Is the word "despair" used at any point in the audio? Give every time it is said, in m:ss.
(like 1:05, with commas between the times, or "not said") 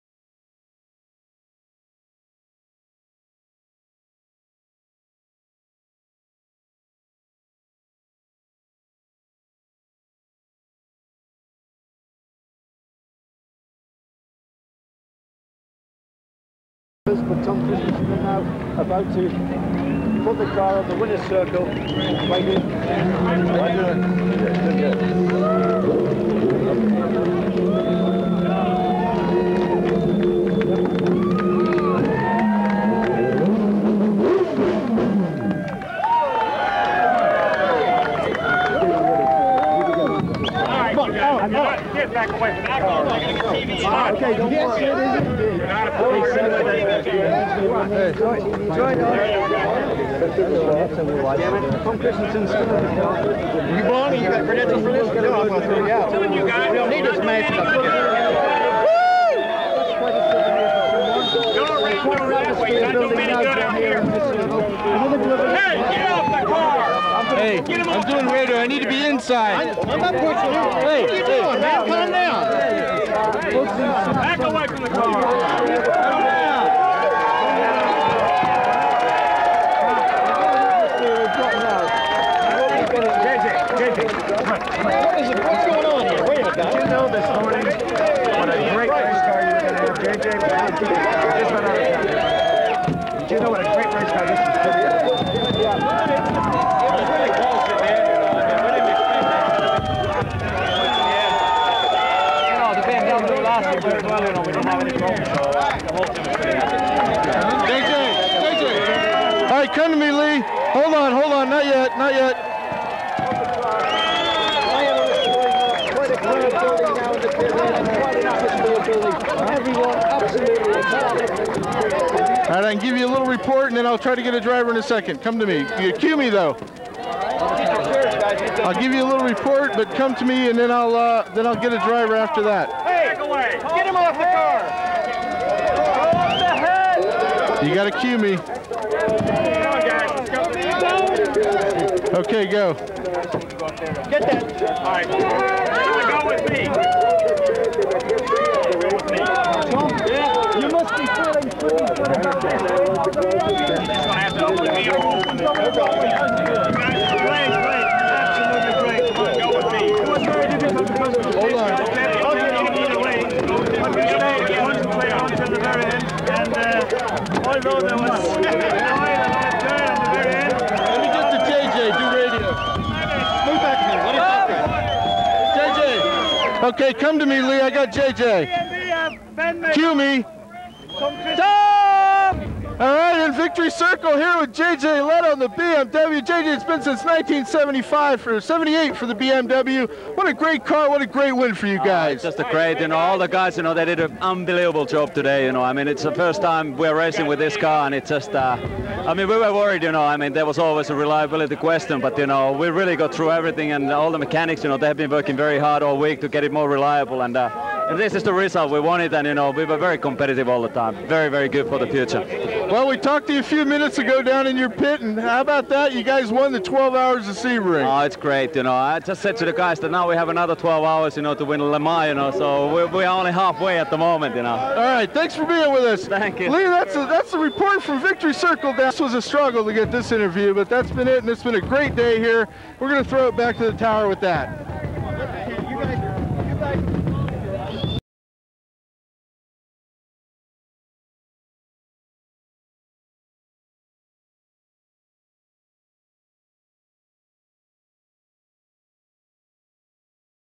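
not said.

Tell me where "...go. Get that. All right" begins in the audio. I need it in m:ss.
2:22.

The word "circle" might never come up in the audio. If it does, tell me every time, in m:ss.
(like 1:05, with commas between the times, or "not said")
0:21, 3:03, 3:48.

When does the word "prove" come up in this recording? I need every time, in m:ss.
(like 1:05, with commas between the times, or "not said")
not said.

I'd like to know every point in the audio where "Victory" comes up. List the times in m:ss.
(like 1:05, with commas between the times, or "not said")
3:03, 3:48.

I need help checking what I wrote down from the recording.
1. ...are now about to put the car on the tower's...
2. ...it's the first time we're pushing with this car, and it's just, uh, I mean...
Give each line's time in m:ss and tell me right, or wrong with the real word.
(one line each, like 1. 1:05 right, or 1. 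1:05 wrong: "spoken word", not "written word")
1. 0:18 wrong: "winner", not "tower"
2. 3:15 wrong: "racing", not "pushing".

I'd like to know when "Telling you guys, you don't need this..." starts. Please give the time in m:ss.
0:56.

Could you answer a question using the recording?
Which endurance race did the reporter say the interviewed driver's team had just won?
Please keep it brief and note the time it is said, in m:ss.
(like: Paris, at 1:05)
12 Hours of Sebring, at 3:36.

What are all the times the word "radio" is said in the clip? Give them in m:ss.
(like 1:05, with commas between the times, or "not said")
1:08.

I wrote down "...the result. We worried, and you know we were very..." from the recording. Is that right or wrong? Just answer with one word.
wrong.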